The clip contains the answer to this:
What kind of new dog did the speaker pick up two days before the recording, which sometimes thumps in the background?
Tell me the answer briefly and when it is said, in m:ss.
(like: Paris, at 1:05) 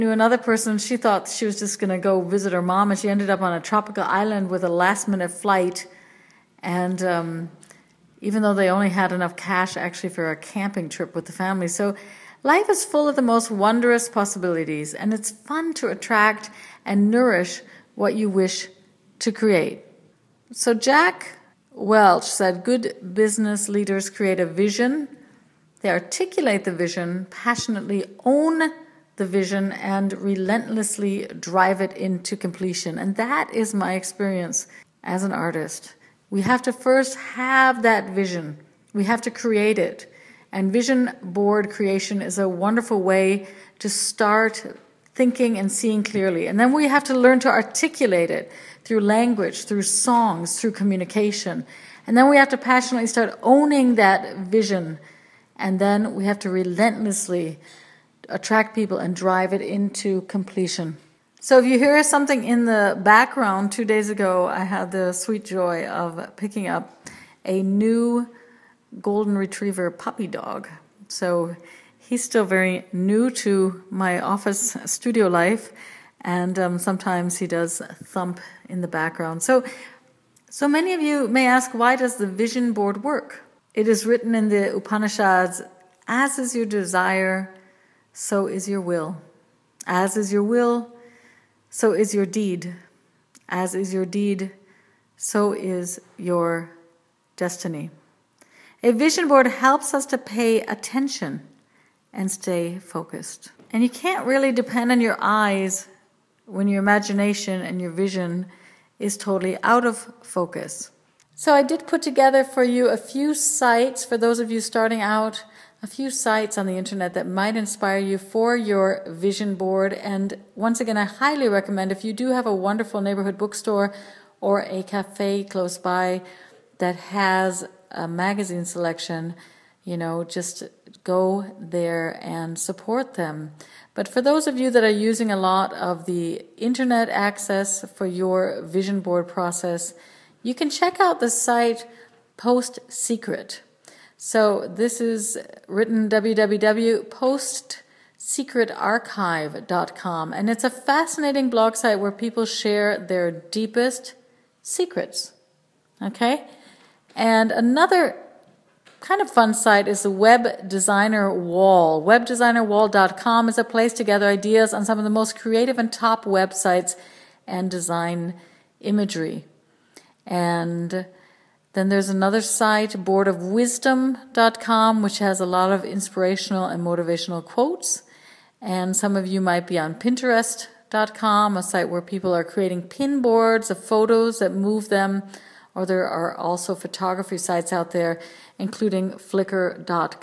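golden retriever, at 1:09.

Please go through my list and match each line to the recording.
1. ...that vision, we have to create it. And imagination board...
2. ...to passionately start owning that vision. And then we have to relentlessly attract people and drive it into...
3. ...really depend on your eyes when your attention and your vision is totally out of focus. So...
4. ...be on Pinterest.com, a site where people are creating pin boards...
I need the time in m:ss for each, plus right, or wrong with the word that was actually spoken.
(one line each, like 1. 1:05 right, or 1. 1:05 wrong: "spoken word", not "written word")
1. 0:37 wrong: "vision", not "imagination"
2. 0:52 right
3. 1:44 wrong: "imagination", not "attention"
4. 2:59 right.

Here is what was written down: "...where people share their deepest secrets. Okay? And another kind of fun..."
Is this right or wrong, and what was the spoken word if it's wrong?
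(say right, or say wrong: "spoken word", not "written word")
right.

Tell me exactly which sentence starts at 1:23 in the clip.
It is written in the Upanishads, as is your desire, so is your will.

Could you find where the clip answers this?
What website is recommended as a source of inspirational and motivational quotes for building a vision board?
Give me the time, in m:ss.
2:52.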